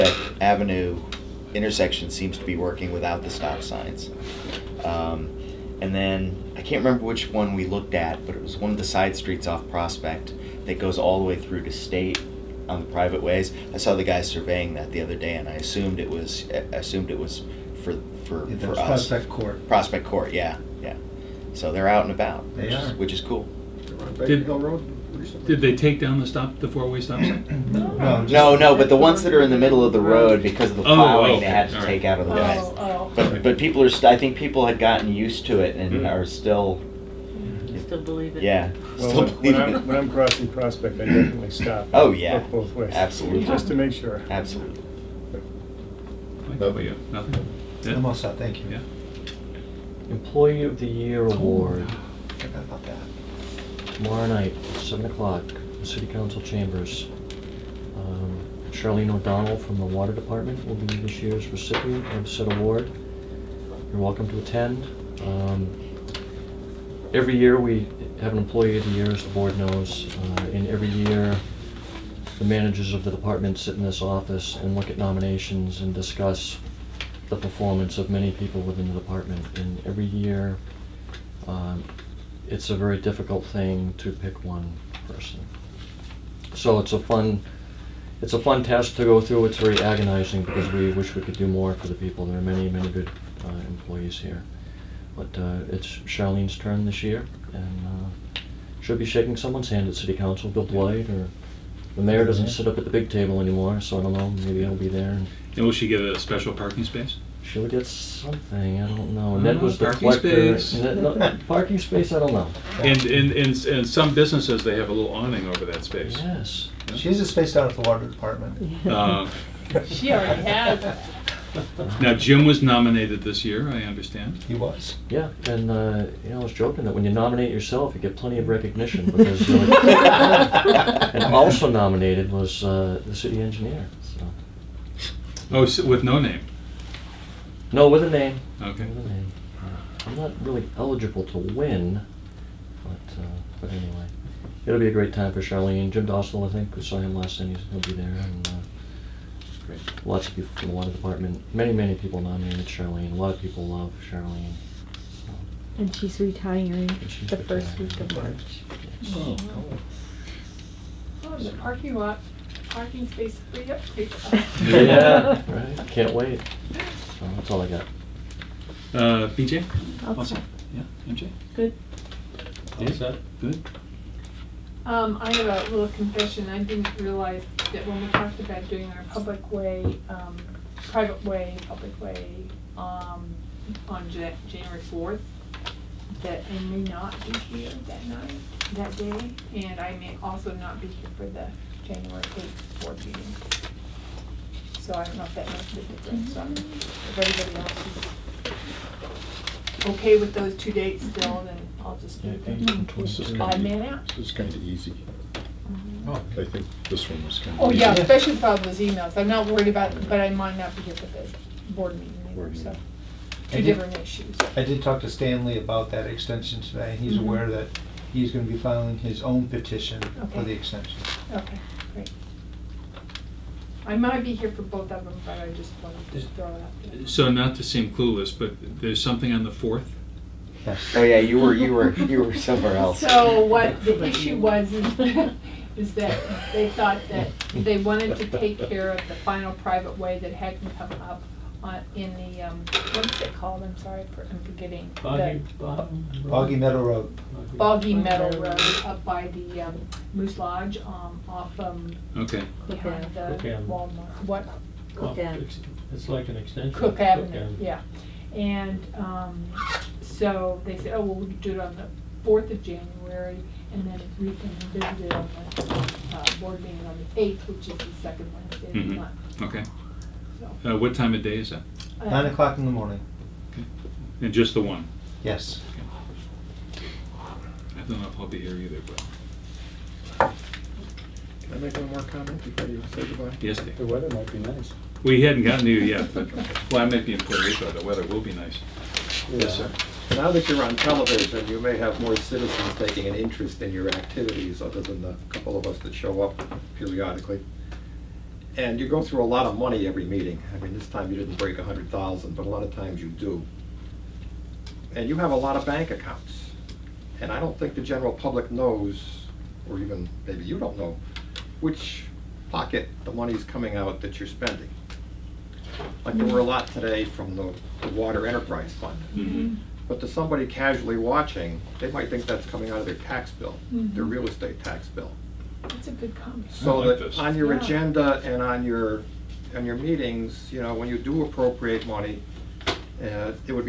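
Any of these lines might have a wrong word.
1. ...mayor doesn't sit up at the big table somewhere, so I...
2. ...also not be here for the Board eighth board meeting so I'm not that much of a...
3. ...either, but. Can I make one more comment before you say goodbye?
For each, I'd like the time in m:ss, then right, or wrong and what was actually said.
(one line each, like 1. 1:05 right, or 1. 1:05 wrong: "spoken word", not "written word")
1. 1:42 wrong: "anymore", not "somewhere"
2. 3:10 wrong: "January", not "Board"
3. 4:38 right.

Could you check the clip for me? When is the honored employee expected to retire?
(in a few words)
first week of March.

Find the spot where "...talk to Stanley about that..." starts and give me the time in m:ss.
3:34.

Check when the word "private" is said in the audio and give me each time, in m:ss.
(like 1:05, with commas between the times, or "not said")
0:12, 3:00, 3:59.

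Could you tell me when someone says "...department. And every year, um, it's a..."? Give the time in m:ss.
1:18.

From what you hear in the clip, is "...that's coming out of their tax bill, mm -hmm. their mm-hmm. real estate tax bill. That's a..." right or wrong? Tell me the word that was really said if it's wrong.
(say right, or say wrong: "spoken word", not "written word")
right.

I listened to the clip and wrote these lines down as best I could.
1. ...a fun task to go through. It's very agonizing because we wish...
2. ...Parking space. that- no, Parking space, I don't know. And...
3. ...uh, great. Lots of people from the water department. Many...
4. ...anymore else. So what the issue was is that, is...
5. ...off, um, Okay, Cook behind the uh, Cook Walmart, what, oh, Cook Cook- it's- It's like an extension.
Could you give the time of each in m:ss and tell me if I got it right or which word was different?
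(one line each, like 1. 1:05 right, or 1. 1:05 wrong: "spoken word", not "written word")
1. 1:28 right
2. 1:49 right
3. 2:28 right
4. 3:52 wrong: "somewhere", not "anymore"
5. 4:11 right.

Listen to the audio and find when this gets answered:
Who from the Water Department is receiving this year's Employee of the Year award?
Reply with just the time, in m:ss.
0:58.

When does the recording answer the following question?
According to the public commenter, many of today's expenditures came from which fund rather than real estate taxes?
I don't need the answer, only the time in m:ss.
5:17.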